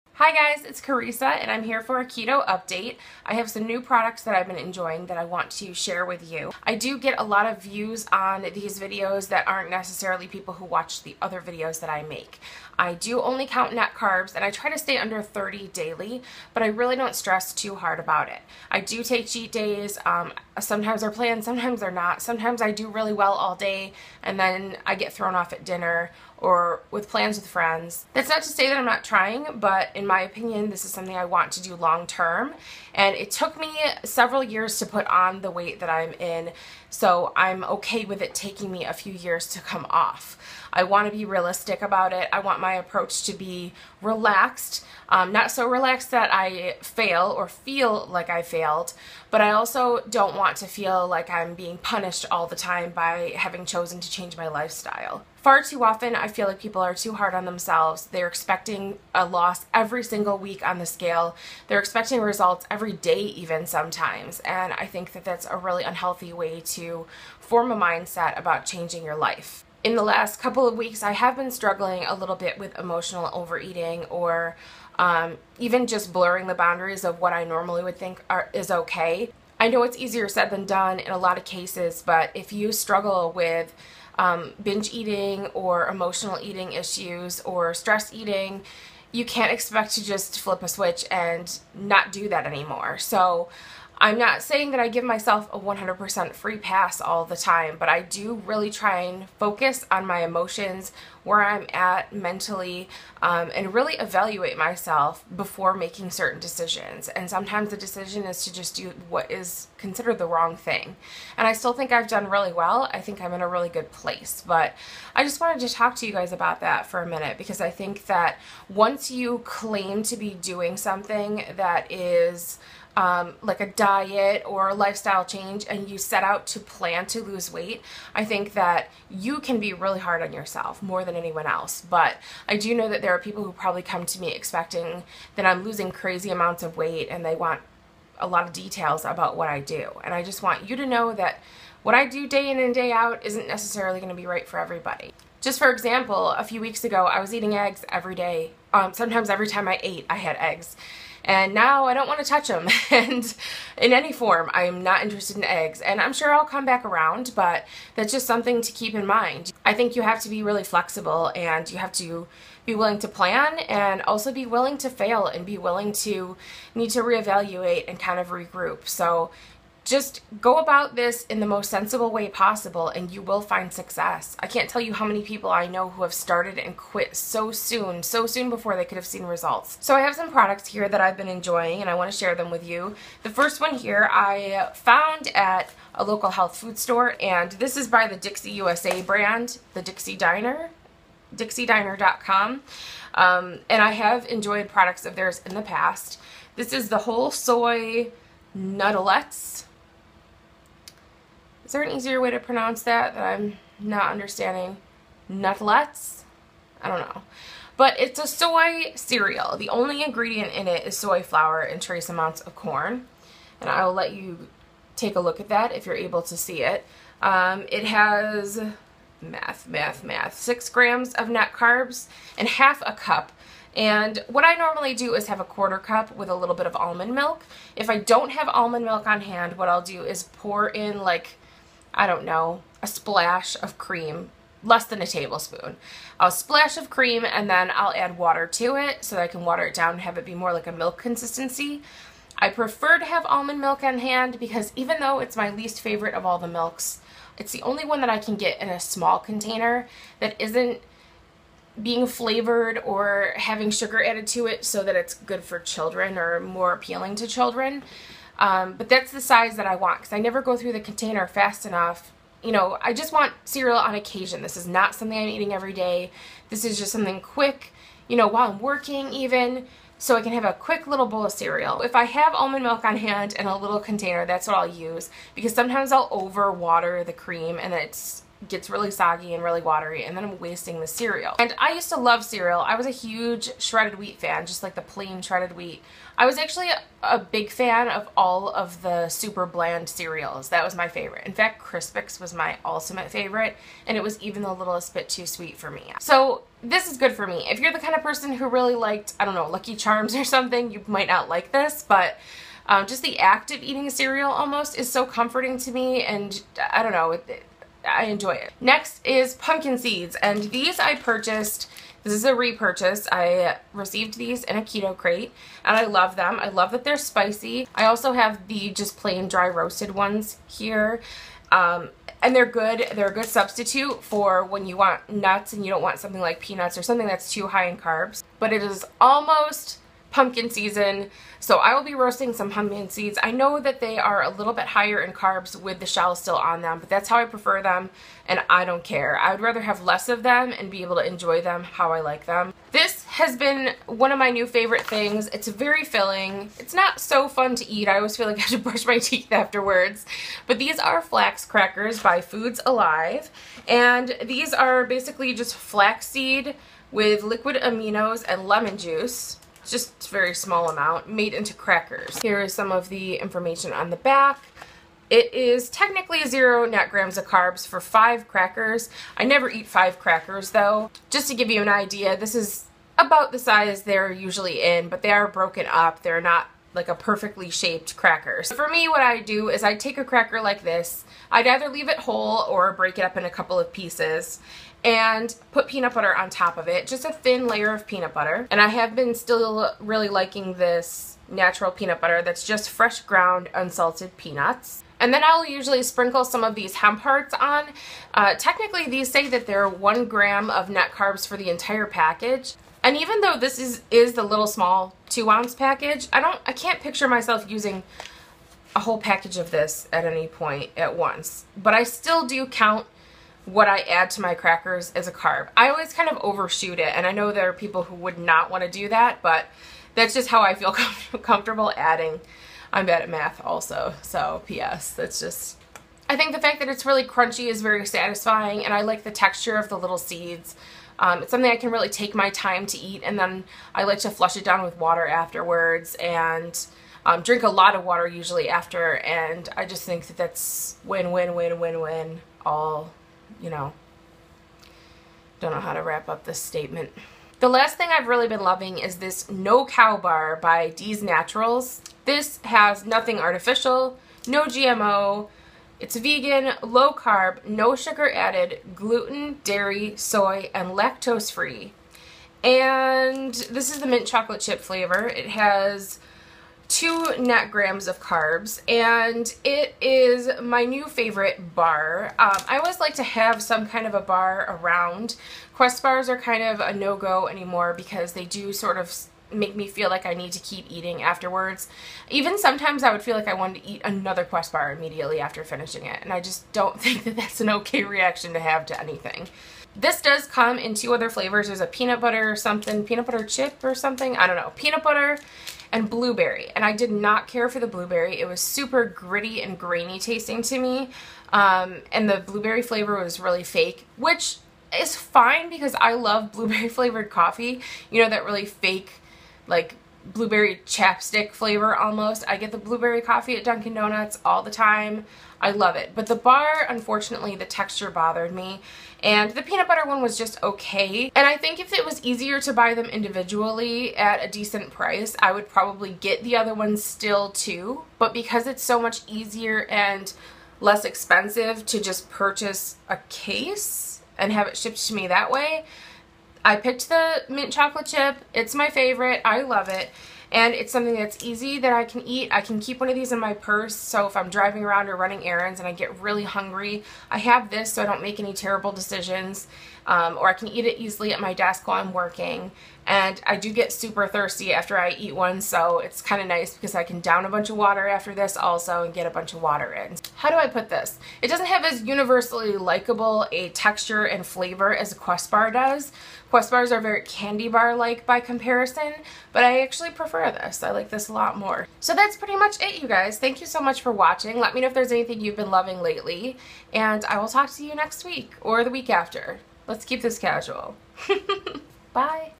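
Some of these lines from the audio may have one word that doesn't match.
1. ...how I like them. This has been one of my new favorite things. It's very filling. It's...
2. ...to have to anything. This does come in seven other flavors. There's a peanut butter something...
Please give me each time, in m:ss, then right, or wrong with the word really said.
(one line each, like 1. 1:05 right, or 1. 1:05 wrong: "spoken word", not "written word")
1. 5:41 right
2. 8:08 wrong: "two", not "seven".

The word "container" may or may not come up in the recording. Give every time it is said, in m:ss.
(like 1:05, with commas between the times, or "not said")
4:09, 4:20, 4:33.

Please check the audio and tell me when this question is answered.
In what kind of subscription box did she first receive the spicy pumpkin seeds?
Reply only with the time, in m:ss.
5:14.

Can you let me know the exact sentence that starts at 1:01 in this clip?
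They're expecting results every day, even sometimes.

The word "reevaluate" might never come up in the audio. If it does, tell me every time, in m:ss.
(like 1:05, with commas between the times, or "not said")
2:47.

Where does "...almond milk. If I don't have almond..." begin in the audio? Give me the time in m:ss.
3:46.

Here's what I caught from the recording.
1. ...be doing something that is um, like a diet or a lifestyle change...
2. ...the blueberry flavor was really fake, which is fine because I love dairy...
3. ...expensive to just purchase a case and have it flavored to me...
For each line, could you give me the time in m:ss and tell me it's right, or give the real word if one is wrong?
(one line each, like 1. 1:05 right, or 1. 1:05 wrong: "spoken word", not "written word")
1. 2:00 right
2. 8:22 wrong: "blueberry", not "dairy"
3. 8:50 wrong: "shipped", not "flavored".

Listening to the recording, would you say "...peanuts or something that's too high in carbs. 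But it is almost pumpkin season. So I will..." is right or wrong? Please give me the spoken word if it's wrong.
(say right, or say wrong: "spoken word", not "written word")
right.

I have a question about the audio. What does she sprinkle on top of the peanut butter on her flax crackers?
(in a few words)
Hemp hearts.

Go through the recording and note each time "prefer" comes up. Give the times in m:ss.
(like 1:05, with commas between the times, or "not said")
4:02, 5:37, 9:29.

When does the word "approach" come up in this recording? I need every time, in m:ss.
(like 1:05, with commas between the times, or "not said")
0:42.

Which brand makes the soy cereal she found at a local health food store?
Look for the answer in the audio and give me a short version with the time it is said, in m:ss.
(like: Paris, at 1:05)
Dixie USA, at 3:08.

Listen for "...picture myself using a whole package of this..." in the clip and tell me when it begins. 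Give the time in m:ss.
6:46.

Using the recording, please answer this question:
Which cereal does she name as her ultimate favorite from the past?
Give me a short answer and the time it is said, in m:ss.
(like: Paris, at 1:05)
Crispix, at 4:51.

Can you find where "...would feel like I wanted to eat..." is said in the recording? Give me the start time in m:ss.
8:02.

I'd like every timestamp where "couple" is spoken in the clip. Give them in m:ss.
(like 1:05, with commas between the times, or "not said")
1:10, 6:23.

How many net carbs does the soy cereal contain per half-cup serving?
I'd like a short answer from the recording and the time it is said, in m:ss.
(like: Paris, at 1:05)
6 grams, at 3:40.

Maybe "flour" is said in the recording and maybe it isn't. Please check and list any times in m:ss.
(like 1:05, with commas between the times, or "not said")
3:31.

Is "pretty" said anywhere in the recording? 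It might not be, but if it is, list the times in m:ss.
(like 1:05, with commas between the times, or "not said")
9:32.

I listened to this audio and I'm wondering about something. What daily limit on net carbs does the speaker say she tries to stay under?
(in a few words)
30.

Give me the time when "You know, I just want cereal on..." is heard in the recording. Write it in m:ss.
4:22.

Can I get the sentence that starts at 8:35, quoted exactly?
But the bar, unfortunately, the texture bothered me.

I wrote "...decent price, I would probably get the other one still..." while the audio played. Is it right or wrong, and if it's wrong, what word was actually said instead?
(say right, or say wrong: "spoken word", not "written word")
right.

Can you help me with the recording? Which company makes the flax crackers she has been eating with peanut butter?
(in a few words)
Foods Alive.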